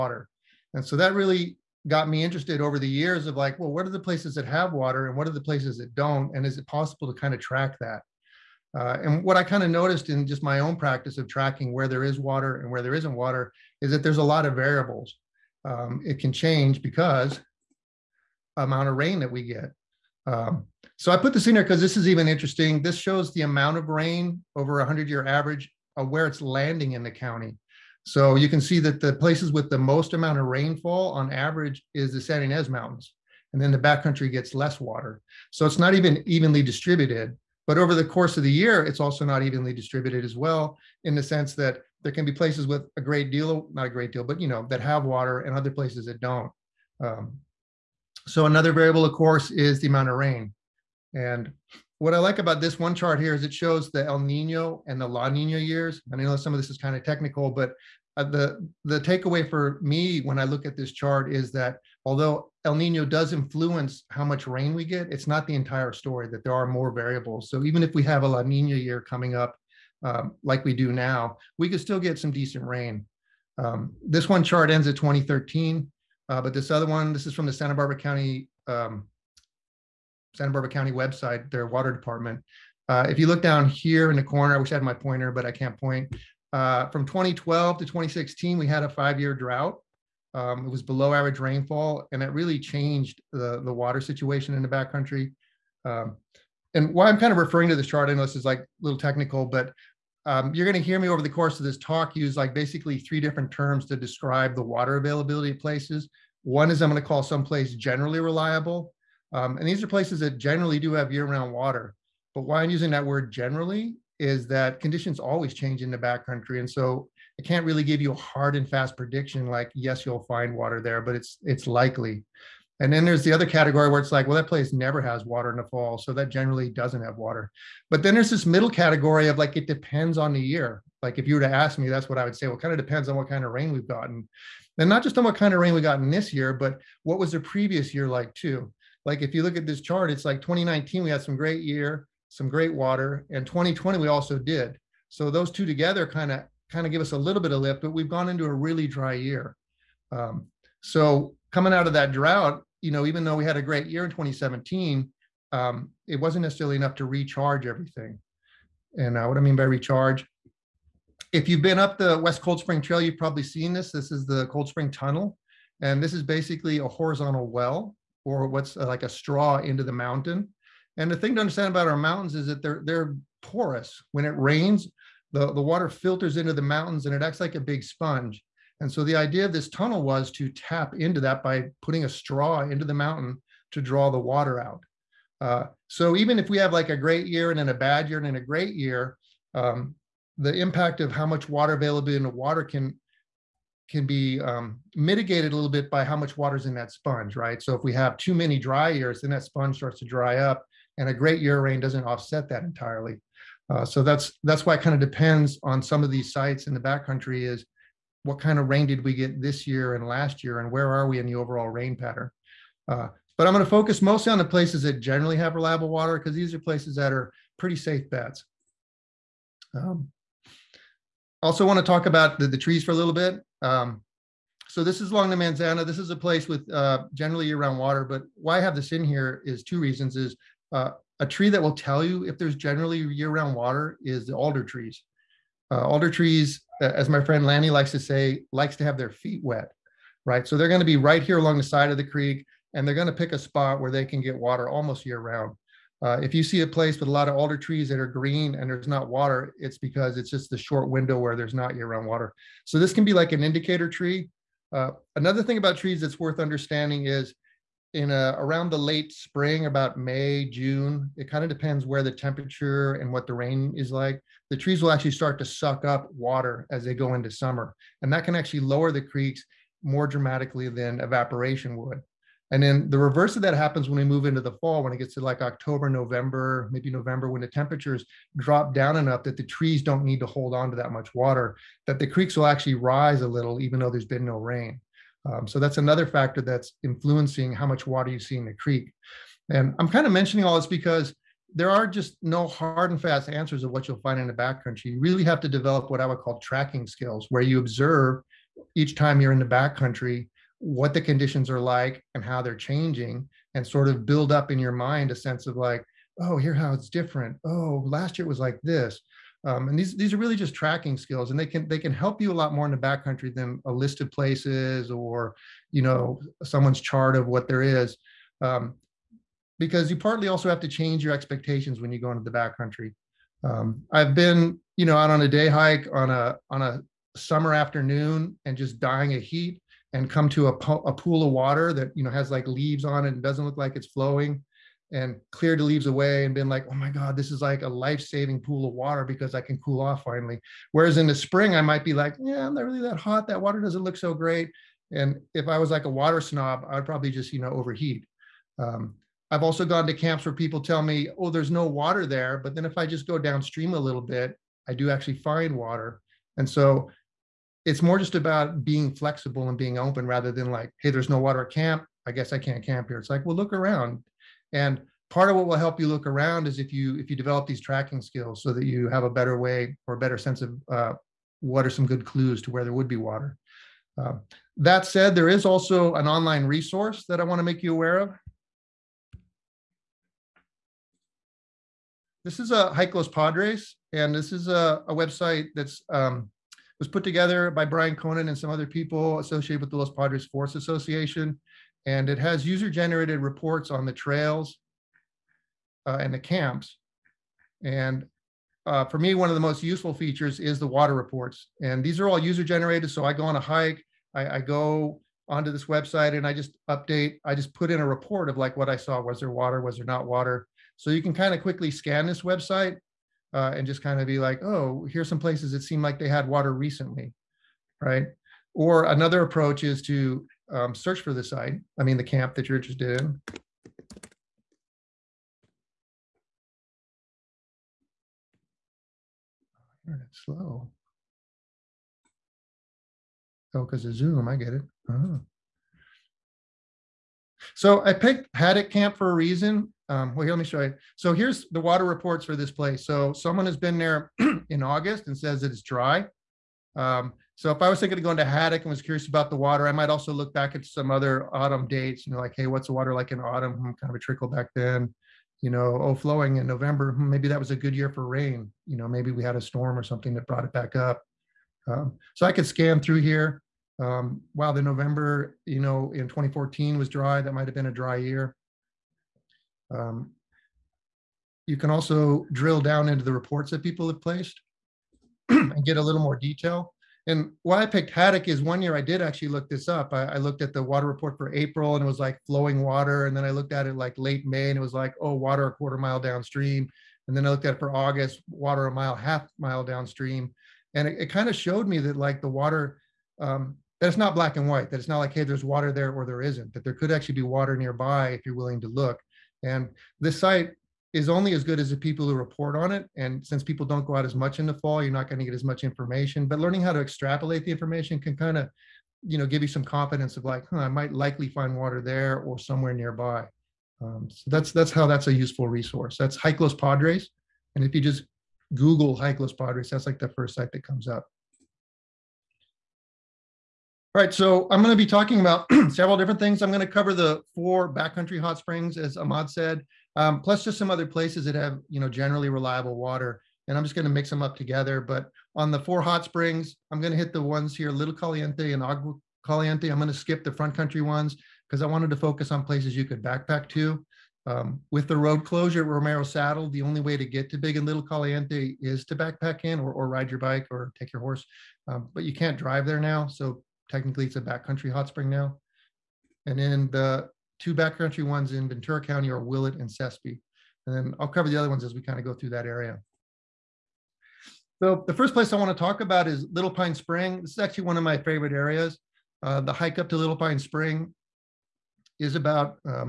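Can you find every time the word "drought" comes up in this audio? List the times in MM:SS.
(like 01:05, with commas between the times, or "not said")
01:29, 02:32.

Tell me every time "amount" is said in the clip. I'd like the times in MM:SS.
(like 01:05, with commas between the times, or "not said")
00:18, 00:23, 00:30, 00:49.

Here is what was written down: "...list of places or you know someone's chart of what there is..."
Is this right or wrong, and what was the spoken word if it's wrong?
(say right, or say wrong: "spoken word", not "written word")
right.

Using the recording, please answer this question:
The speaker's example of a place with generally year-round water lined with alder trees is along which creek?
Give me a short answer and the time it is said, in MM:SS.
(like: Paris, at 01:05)
Manzana, at 03:45.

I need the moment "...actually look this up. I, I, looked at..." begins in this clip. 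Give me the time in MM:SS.
07:59.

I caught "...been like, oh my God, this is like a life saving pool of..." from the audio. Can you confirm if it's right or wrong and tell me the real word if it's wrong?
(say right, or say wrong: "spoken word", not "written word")
right.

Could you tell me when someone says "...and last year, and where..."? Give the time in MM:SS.
03:29.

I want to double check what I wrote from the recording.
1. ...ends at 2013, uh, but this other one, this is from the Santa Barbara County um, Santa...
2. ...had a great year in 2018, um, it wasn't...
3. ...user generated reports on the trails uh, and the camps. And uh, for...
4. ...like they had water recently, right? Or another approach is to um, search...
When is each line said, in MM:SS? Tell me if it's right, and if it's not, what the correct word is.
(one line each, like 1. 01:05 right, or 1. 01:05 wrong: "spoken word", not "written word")
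1. 01:14 right
2. 02:33 wrong: "2017", not "2018"
3. 06:32 right
4. 06:55 right.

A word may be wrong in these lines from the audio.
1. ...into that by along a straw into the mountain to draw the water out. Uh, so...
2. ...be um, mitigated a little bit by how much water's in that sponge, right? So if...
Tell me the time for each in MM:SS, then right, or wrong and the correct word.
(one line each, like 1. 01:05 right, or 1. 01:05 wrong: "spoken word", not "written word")
1. 03:00 wrong: "putting", not "along"
2. 03:14 right.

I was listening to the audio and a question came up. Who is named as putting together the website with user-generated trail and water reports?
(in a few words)
Bryan Conant.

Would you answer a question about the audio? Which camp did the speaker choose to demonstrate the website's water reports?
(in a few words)
Haddock Camp.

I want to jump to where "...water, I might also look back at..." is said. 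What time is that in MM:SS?
07:29.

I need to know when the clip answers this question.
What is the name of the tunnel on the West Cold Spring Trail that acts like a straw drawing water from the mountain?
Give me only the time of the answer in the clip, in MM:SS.
02:44.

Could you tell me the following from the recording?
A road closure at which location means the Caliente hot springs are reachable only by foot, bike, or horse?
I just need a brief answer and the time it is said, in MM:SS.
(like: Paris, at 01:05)
Romero Saddle, at 09:05.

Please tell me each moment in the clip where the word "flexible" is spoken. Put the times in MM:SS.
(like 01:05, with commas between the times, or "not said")
05:58.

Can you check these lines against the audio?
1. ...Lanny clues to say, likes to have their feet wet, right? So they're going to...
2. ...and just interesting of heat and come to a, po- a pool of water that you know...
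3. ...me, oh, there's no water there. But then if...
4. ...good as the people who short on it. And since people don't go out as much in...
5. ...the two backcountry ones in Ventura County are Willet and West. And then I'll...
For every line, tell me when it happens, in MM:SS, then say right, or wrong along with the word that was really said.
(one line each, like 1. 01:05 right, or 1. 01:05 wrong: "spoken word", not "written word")
1. 03:57 wrong: "likes", not "clues"
2. 05:28 wrong: "dying", not "interesting"
3. 05:50 right
4. 08:21 wrong: "report", not "short"
5. 09:16 wrong: "Sespe", not "West".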